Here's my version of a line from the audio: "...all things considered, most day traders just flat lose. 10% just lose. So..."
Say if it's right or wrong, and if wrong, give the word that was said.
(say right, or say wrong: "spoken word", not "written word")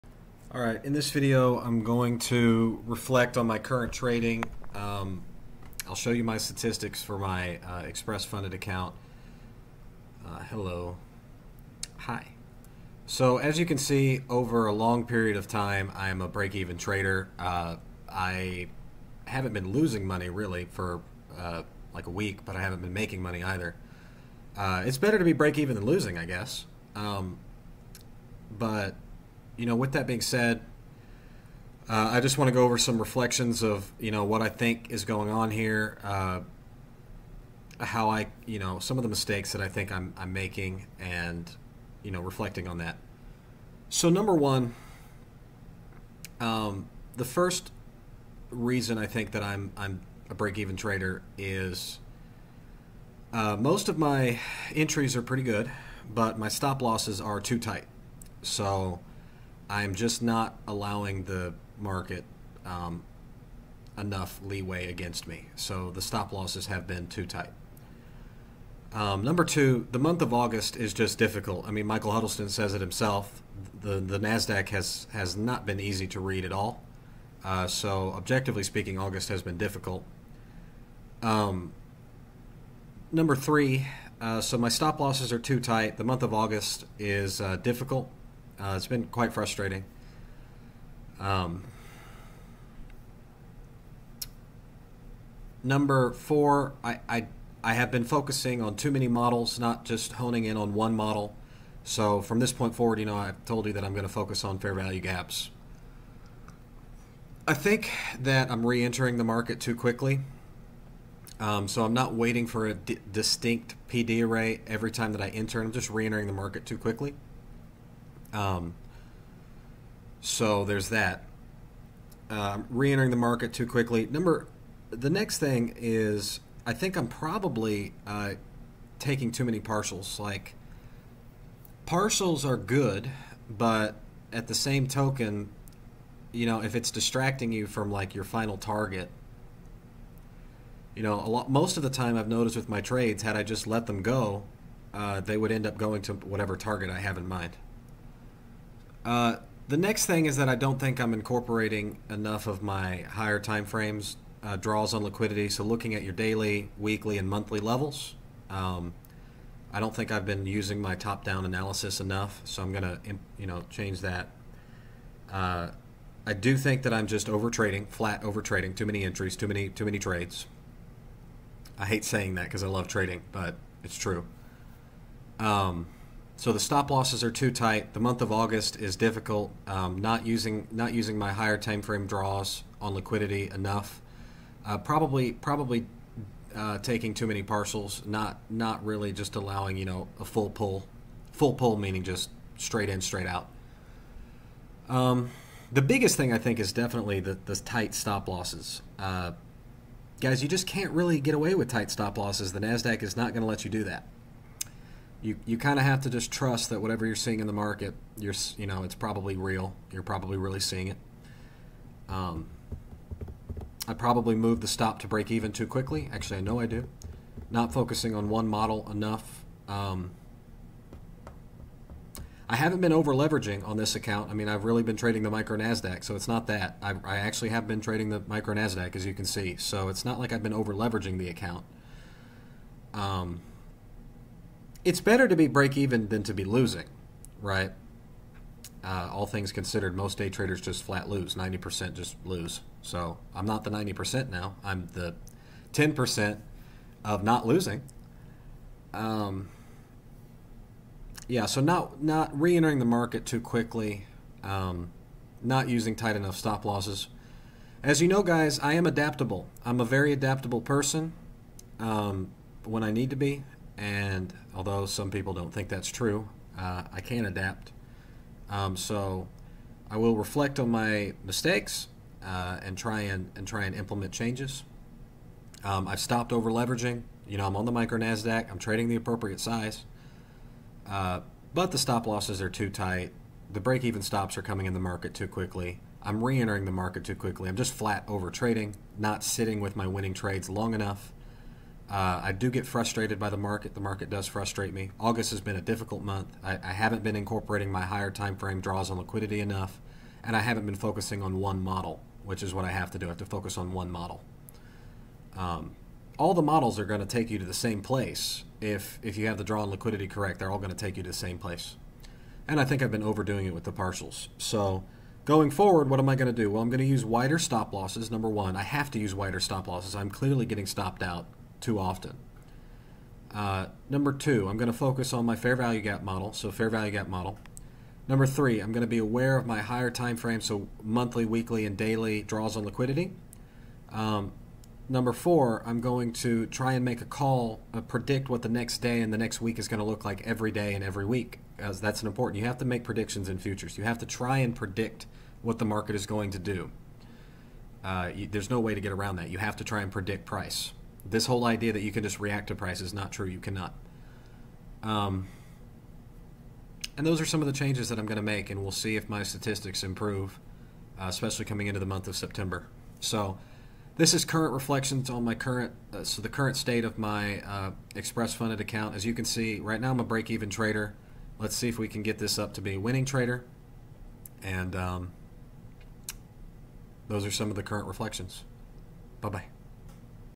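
wrong: "90", not "10".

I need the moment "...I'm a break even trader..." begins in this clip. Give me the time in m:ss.
0:49.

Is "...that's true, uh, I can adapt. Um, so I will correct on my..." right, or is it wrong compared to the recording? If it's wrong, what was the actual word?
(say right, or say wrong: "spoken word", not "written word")
wrong: "reflect", not "correct".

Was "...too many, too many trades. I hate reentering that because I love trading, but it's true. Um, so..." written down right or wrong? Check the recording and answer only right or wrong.
wrong.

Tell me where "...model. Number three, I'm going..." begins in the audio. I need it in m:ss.
5:27.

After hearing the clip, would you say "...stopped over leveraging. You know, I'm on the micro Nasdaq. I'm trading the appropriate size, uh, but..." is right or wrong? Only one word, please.
right.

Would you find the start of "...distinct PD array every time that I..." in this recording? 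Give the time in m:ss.
1:52.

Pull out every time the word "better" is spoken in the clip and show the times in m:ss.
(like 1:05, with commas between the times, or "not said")
0:24, 3:55.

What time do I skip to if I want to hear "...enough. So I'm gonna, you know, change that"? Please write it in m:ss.
2:42.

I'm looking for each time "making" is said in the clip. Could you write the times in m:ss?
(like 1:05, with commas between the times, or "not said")
0:22, 0:40.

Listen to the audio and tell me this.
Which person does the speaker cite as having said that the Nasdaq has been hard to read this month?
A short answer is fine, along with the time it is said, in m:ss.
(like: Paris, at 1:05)
Michael Huddleston, at 1:11.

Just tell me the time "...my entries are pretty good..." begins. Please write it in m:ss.
0:53.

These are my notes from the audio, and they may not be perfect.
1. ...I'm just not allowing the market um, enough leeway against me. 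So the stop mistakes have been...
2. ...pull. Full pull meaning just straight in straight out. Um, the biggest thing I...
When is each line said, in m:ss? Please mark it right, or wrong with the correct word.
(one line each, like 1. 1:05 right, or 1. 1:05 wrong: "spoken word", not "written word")
1. 0:59 wrong: "losses", not "mistakes"
2. 3:10 right.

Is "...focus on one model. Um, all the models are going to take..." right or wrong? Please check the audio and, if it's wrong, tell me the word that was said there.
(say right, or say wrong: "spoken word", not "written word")
right.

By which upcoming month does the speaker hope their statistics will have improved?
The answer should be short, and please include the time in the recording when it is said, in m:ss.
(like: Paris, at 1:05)
September, at 6:02.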